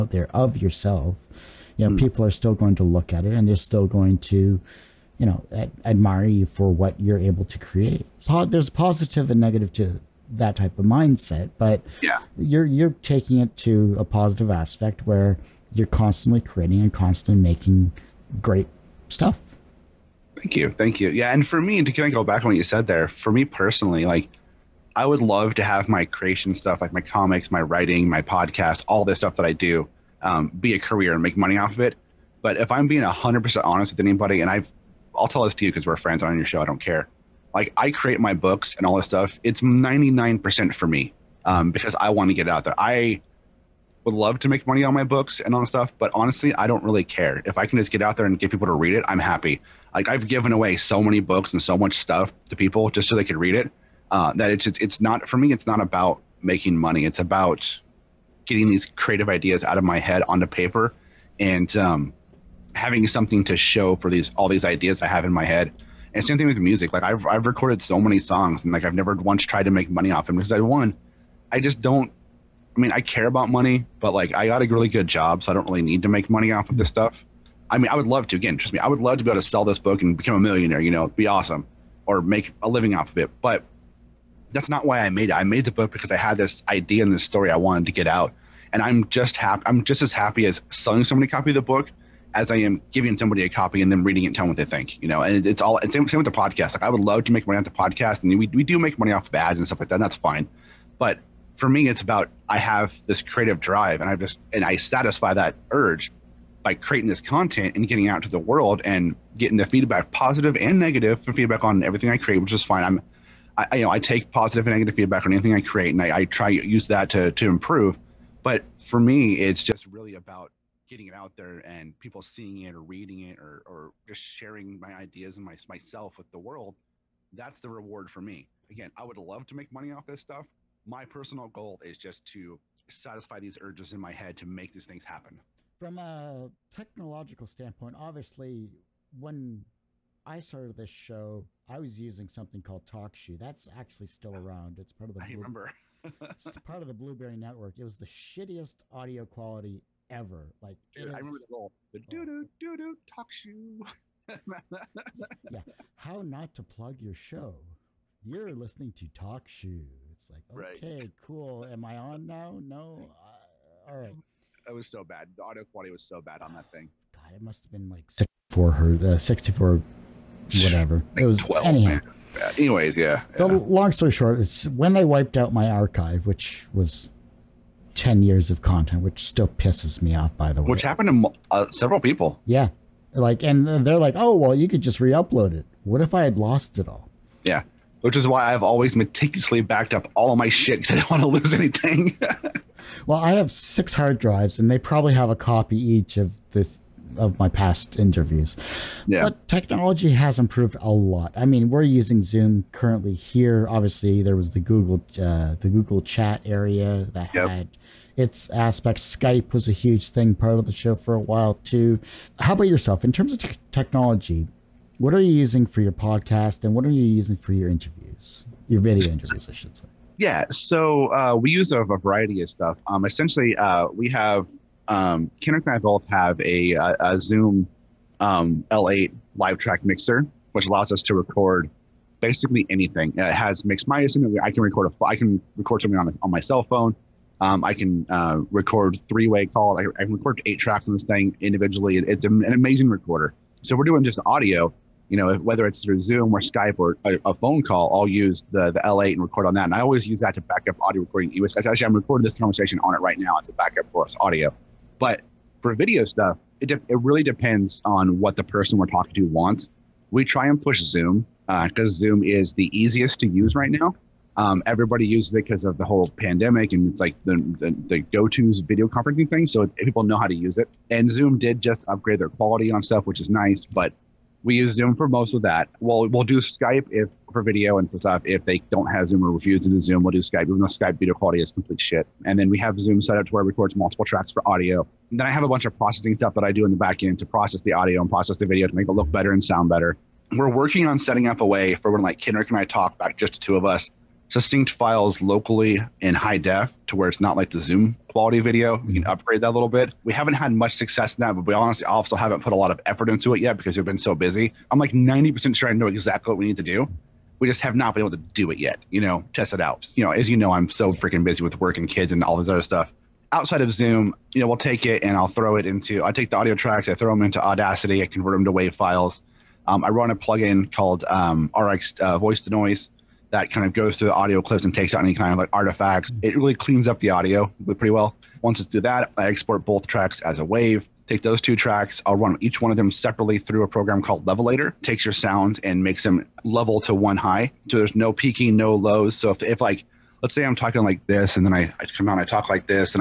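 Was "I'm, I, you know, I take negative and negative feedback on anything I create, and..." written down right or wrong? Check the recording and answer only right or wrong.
wrong.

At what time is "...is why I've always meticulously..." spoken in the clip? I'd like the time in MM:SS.
03:08.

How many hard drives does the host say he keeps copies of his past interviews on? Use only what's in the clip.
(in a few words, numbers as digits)
6.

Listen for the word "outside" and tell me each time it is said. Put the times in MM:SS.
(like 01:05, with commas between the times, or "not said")
05:13.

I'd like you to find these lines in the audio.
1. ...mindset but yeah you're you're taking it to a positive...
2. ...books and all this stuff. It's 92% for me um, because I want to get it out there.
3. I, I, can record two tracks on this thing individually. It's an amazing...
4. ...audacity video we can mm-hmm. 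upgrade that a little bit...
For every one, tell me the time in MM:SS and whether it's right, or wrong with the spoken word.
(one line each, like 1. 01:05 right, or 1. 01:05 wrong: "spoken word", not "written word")
1. 00:10 right
2. 00:38 wrong: "99", not "92"
3. 03:59 wrong: "eight", not "two"
4. 04:58 wrong: "quality", not "audacity".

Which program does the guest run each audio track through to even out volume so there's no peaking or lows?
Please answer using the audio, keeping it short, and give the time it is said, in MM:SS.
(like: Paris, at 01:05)
Levelator, at 05:34.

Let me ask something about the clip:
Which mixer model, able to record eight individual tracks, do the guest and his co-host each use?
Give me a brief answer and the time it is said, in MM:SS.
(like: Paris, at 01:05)
Zoom L8 LiveTrak, at 03:47.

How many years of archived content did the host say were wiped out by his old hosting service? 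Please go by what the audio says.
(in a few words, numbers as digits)
10 years.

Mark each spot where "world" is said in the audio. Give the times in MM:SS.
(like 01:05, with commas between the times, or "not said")
01:48, 02:06.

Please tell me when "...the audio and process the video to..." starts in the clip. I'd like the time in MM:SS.
04:47.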